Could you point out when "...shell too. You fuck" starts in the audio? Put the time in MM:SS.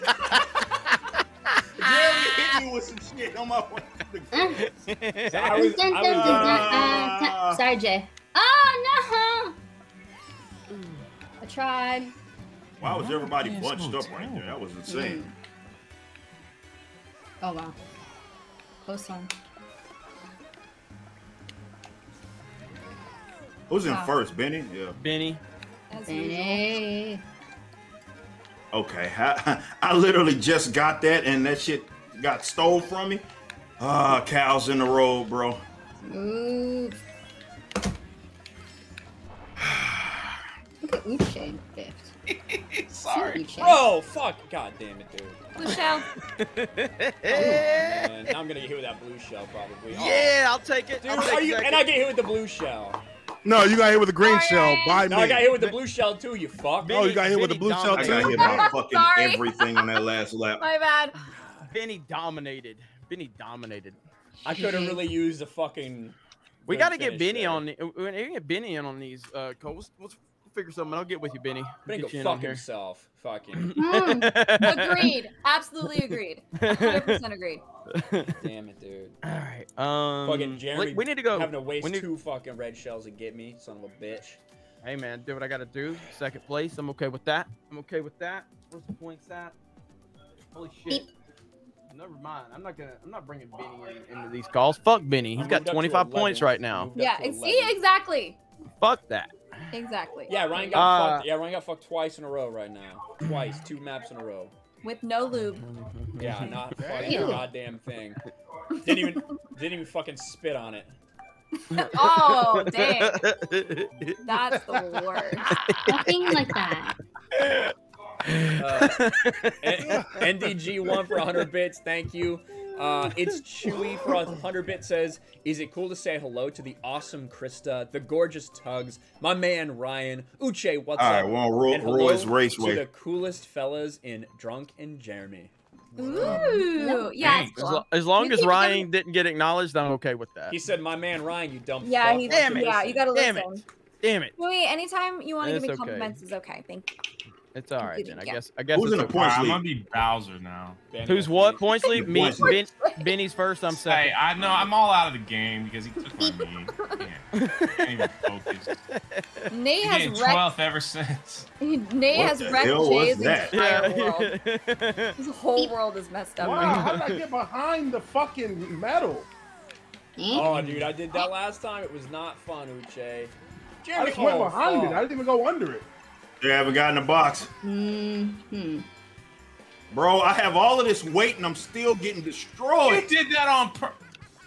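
00:55.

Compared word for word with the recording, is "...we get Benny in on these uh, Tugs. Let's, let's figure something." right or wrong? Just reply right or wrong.
wrong.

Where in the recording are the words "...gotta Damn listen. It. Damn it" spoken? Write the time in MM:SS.
02:22.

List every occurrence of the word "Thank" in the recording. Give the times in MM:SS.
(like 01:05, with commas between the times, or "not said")
02:01, 02:26.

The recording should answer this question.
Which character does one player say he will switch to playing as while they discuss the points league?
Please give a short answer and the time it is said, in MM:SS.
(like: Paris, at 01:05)
Bowser, at 02:29.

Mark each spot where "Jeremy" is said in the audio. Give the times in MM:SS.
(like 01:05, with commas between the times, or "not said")
01:20, 02:14, 02:53.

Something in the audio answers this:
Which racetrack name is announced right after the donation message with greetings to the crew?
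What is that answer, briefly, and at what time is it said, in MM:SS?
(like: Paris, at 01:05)
Roy's Raceway, at 02:11.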